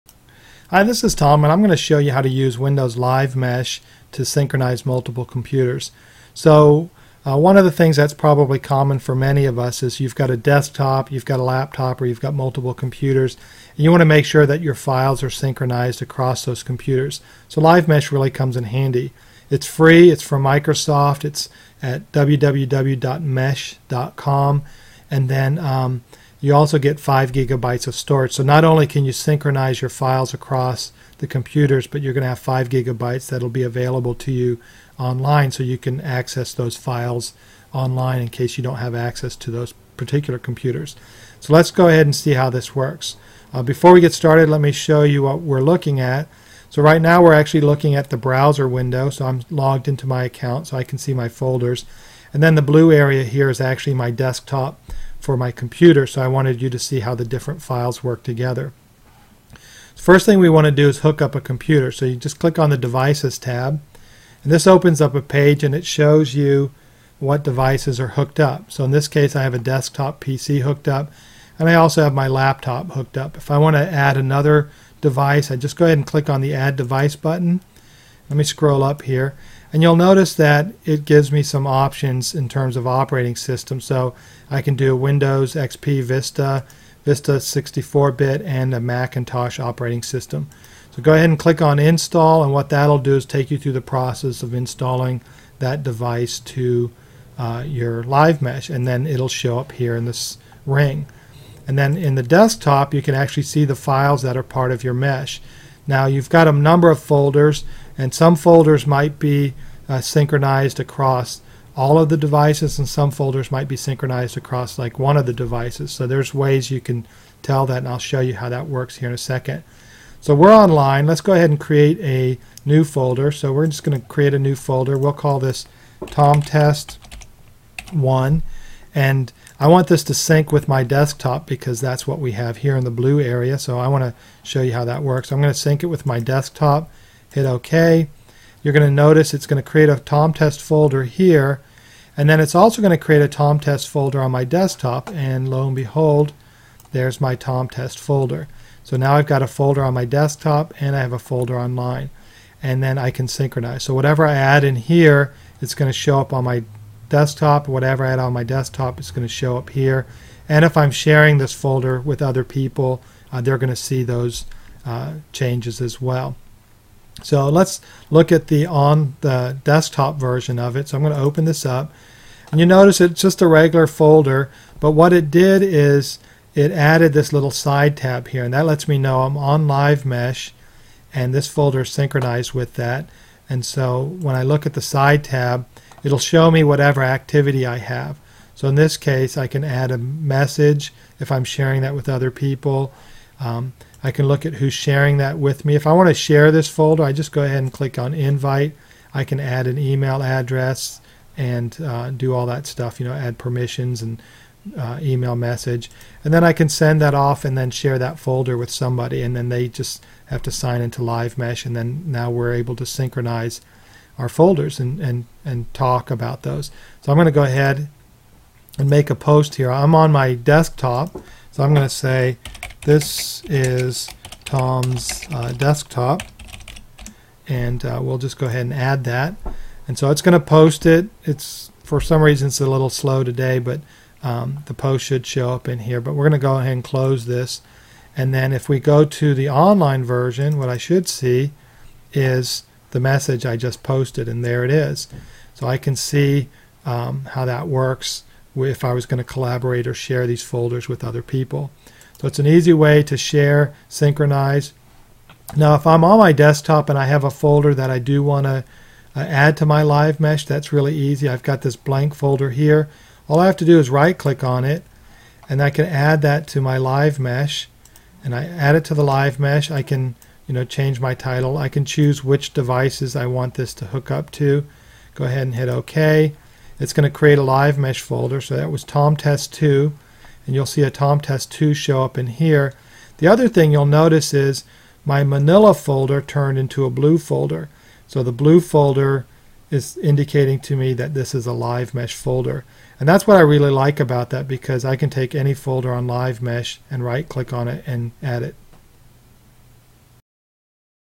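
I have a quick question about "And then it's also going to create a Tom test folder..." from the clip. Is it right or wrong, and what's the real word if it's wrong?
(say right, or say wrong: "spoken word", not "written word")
right.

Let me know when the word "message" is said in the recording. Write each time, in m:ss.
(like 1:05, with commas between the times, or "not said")
3:09, 3:25, 4:02.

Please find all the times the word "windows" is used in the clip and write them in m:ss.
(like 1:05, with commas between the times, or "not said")
0:02, 0:48, 1:24.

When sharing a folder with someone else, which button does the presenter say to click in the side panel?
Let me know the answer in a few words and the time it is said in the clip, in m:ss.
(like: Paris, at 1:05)
invite, at 3:18.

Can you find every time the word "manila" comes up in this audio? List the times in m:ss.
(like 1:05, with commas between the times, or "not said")
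4:45.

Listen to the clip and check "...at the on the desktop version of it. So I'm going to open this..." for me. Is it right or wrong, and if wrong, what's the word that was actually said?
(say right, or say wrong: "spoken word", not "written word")
right.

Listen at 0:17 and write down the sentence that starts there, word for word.
So, Live Mesh really comes in handy.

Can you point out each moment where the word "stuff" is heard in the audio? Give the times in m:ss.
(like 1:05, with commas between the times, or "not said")
3:22.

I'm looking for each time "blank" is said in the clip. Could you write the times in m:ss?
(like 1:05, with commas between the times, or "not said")
4:21.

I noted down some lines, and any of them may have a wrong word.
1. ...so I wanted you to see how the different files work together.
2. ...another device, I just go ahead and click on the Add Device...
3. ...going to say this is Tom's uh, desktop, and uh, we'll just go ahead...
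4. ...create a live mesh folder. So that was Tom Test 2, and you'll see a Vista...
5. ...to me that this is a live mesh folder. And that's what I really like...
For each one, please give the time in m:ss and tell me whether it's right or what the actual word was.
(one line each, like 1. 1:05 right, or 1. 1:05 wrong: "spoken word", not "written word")
1. 0:56 right
2. 1:14 right
3. 3:41 right
4. 4:37 wrong: "Tom", not "Vista"
5. 4:50 right.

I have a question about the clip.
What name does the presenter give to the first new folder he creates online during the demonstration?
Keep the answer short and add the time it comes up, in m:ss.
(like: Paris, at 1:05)
Tom Test 1, at 2:06.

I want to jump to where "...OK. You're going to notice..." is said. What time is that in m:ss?
2:17.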